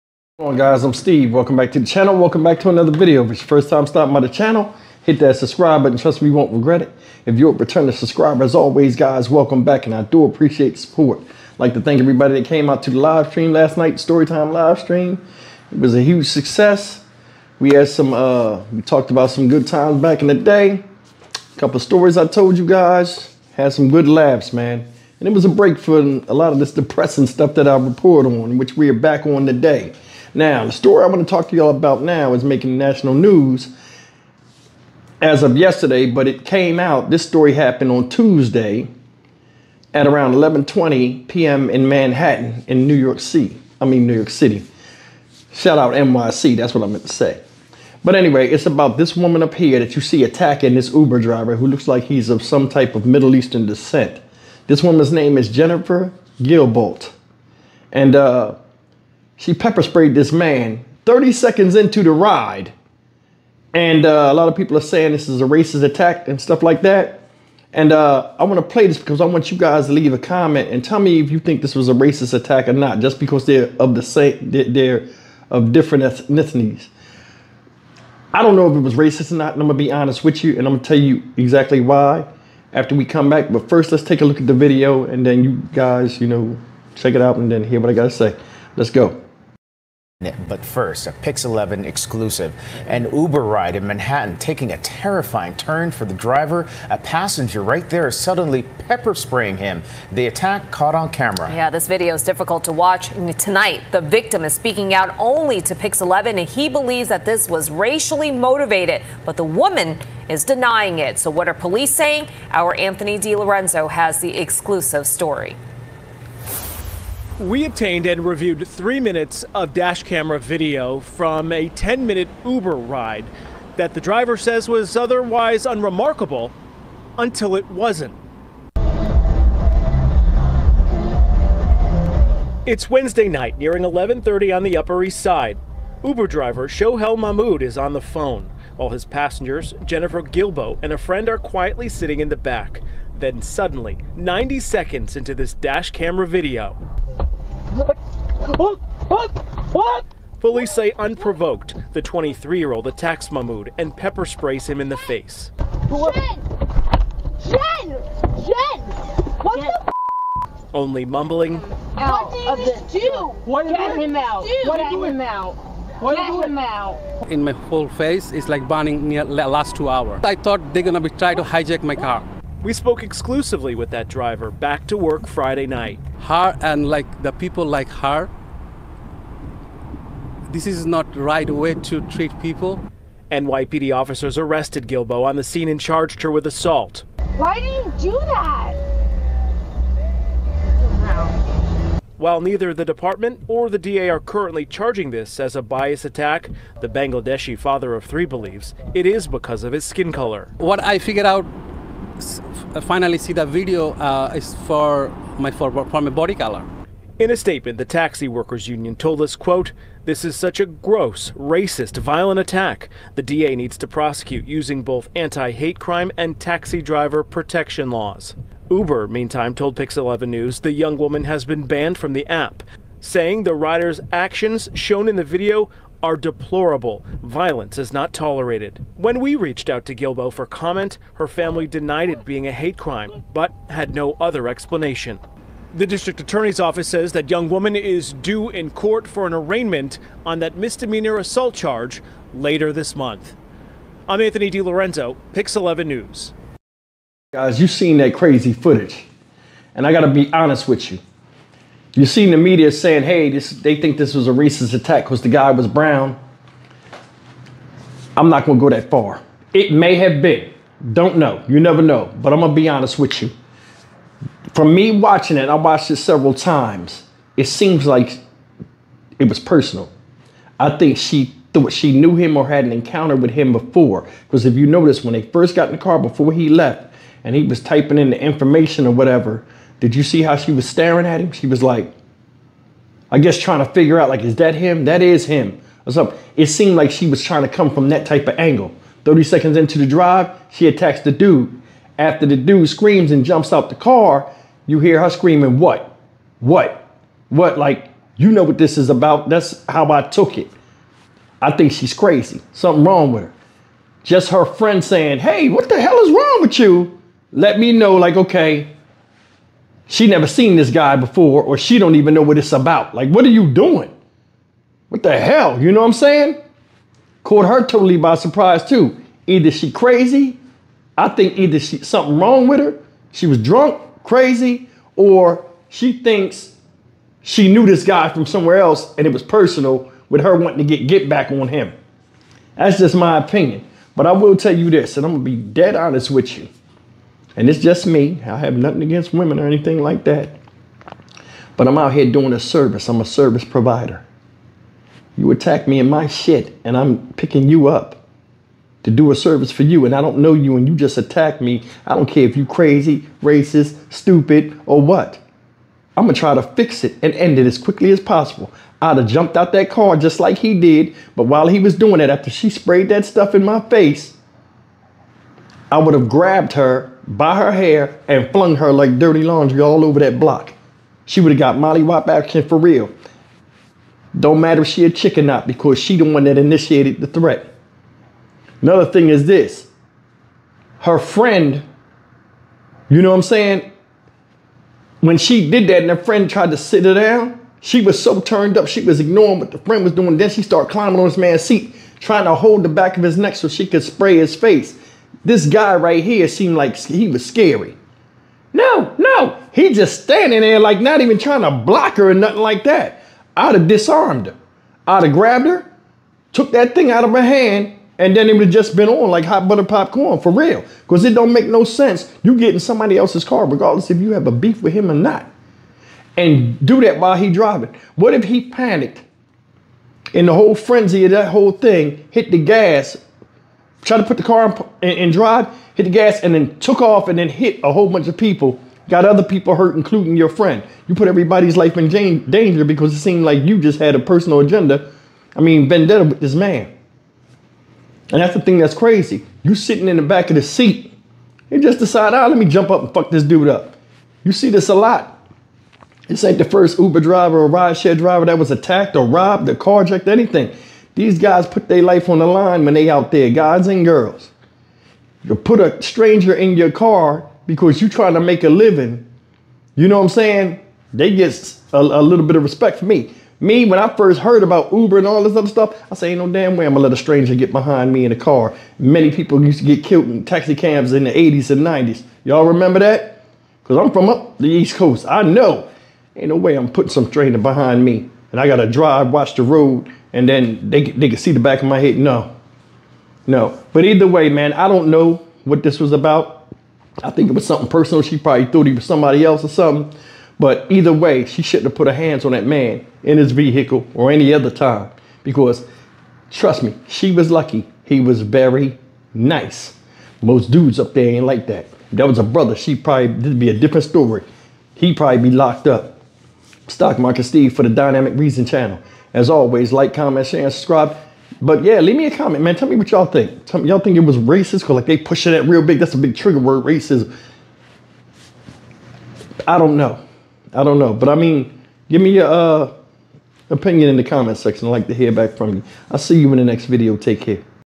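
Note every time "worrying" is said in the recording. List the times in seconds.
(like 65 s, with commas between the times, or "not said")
not said.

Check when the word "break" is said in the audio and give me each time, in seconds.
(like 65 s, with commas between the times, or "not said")
25 s.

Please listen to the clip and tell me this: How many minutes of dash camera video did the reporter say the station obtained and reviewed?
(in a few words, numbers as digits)
3.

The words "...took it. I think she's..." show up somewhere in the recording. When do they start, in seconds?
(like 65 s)
300 s.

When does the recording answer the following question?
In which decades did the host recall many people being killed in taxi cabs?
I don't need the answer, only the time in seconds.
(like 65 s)
471 s.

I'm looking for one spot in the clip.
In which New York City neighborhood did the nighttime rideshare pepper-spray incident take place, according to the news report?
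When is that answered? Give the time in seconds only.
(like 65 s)
134 s.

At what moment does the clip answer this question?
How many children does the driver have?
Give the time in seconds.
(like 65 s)
197 s.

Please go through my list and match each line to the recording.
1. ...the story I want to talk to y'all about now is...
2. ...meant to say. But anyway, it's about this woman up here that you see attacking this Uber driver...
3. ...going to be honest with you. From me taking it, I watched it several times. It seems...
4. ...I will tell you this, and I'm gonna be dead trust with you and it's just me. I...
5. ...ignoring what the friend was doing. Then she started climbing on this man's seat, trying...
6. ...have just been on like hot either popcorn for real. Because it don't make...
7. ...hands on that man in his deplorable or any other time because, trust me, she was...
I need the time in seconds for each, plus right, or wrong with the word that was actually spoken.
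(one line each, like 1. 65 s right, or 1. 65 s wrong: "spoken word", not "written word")
1. 30 s right
2. 46 s right
3. 262 s wrong: "watching", not "taking"
4. 334 s wrong: "honest", not "trust"
5. 388 s right
6. 408 s wrong: "butter", not "either"
7. 491 s wrong: "vehicle", not "deplorable".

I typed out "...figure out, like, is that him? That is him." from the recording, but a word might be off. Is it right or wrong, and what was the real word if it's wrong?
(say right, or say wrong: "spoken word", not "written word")
right.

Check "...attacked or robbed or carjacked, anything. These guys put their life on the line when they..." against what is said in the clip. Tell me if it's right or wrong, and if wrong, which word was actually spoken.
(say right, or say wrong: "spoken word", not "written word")
right.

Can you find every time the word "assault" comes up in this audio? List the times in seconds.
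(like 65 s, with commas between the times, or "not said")
186 s, 241 s.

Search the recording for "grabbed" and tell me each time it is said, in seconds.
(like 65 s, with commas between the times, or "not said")
366 s, 405 s.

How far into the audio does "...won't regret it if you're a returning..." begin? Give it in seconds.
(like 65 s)
6 s.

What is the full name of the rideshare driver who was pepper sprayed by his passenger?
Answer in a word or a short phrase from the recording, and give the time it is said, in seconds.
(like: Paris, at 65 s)
Shohel Mahmoud, at 136 s.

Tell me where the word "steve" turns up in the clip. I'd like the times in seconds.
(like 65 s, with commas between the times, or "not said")
0 s, 507 s.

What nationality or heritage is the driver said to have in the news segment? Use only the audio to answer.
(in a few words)
Bangladeshi.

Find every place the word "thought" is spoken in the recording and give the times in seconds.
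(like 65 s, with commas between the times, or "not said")
170 s, 271 s, 488 s.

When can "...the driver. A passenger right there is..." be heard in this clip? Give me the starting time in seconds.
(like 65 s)
96 s.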